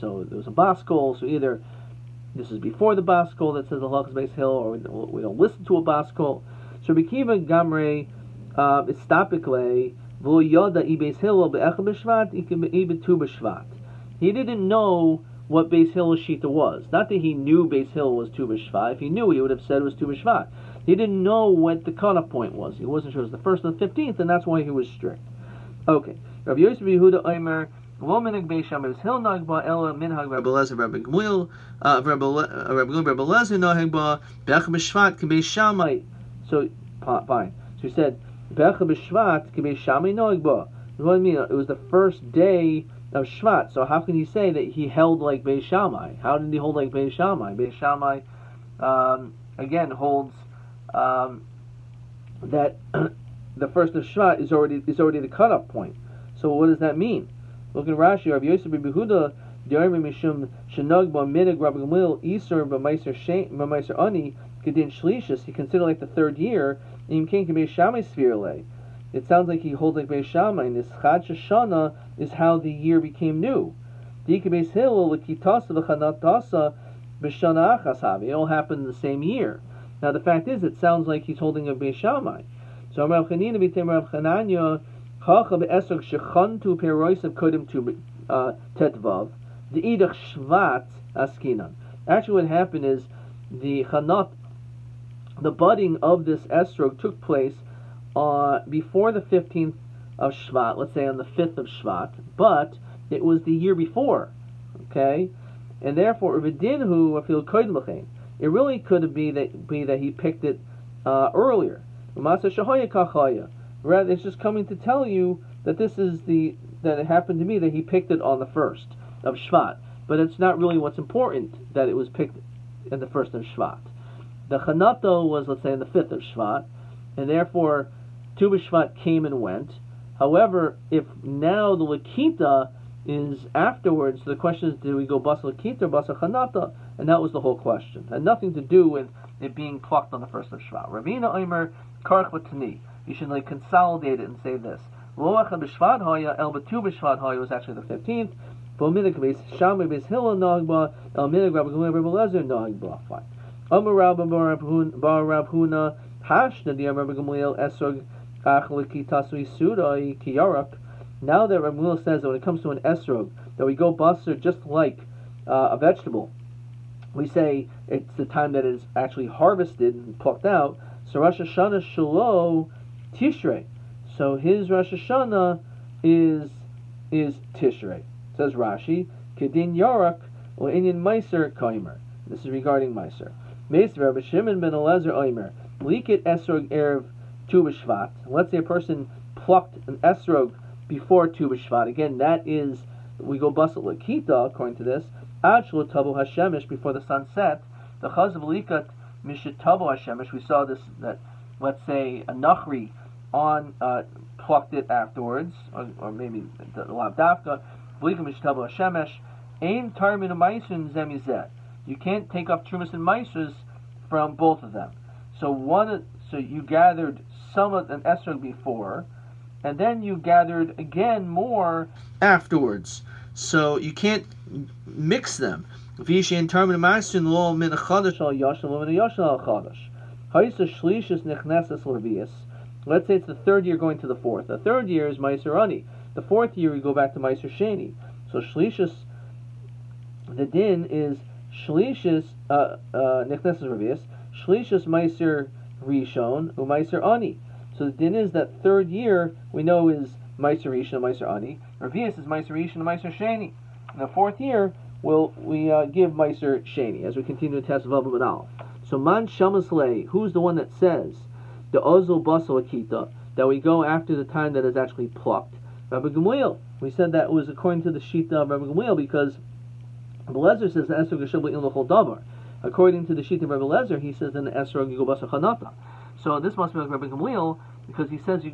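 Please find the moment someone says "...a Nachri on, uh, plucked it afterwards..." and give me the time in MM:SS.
03:22.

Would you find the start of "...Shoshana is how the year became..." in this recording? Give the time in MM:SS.
01:11.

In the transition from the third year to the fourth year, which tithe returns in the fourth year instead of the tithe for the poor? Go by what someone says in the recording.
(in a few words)
Maiser Sheni.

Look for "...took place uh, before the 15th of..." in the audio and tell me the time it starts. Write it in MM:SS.
01:36.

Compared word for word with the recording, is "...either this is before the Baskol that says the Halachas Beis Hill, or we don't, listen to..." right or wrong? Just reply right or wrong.
right.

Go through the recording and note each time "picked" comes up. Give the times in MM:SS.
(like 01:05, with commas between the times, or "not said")
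01:50, 01:57, 02:02.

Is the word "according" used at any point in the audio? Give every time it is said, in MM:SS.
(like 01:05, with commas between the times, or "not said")
03:14, 04:27, 04:32.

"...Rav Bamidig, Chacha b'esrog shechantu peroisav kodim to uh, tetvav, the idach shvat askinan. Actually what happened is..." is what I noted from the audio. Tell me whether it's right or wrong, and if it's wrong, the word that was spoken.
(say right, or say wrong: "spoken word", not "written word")
wrong: "Chananya", not "Bamidig".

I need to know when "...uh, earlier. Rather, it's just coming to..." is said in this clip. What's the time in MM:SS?
01:51.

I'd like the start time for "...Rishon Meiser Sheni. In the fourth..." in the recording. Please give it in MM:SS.
04:12.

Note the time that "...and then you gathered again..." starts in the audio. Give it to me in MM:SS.
03:39.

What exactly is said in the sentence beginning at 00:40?
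What I mean, it was the first day of Shvat.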